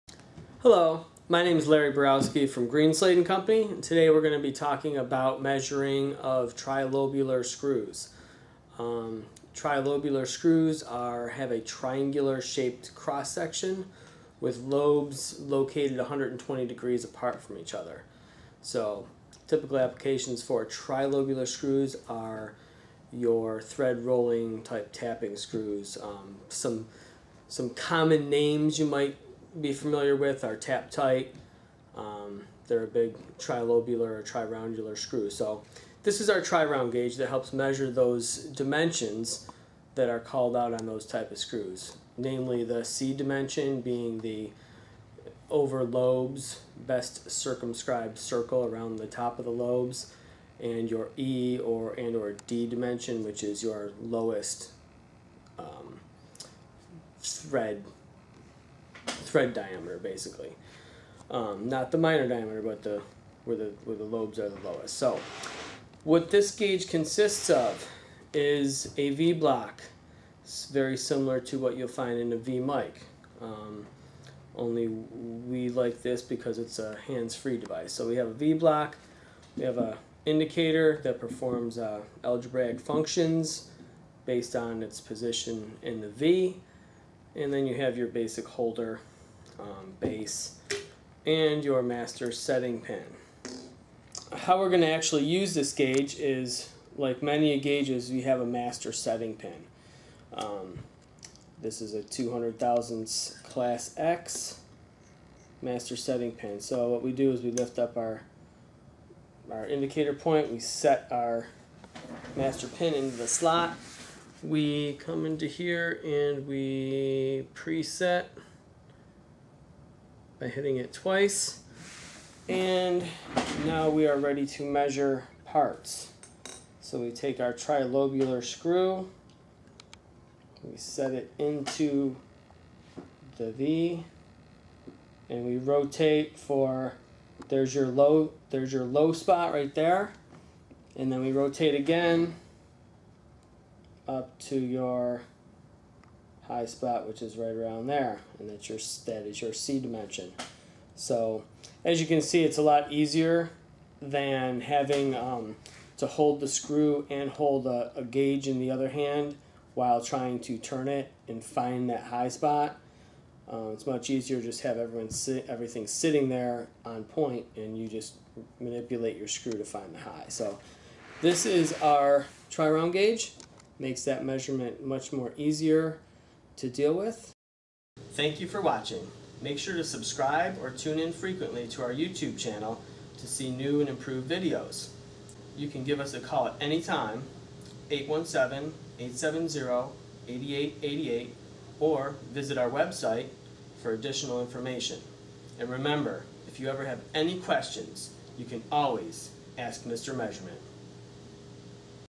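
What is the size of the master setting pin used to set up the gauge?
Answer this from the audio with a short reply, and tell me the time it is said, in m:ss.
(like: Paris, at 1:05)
200 thousandths, at 1:42.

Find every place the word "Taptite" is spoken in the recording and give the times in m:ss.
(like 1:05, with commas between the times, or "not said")
0:30.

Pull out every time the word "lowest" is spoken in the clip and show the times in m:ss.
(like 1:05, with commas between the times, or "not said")
0:53, 1:04.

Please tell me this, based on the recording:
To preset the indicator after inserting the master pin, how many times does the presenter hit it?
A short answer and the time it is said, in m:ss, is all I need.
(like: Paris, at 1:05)
Twice, at 2:00.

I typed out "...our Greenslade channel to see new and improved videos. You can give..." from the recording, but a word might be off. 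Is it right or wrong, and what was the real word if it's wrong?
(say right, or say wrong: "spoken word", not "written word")
wrong: "YouTube", not "Greenslade".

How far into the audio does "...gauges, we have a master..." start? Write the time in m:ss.
1:37.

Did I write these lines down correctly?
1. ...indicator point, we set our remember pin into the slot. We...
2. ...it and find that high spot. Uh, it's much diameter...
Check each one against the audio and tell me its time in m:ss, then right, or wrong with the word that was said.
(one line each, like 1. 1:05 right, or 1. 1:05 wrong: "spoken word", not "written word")
1. 1:49 wrong: "master", not "remember"
2. 2:40 wrong: "easier", not "diameter".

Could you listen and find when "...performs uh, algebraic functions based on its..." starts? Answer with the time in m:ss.
1:21.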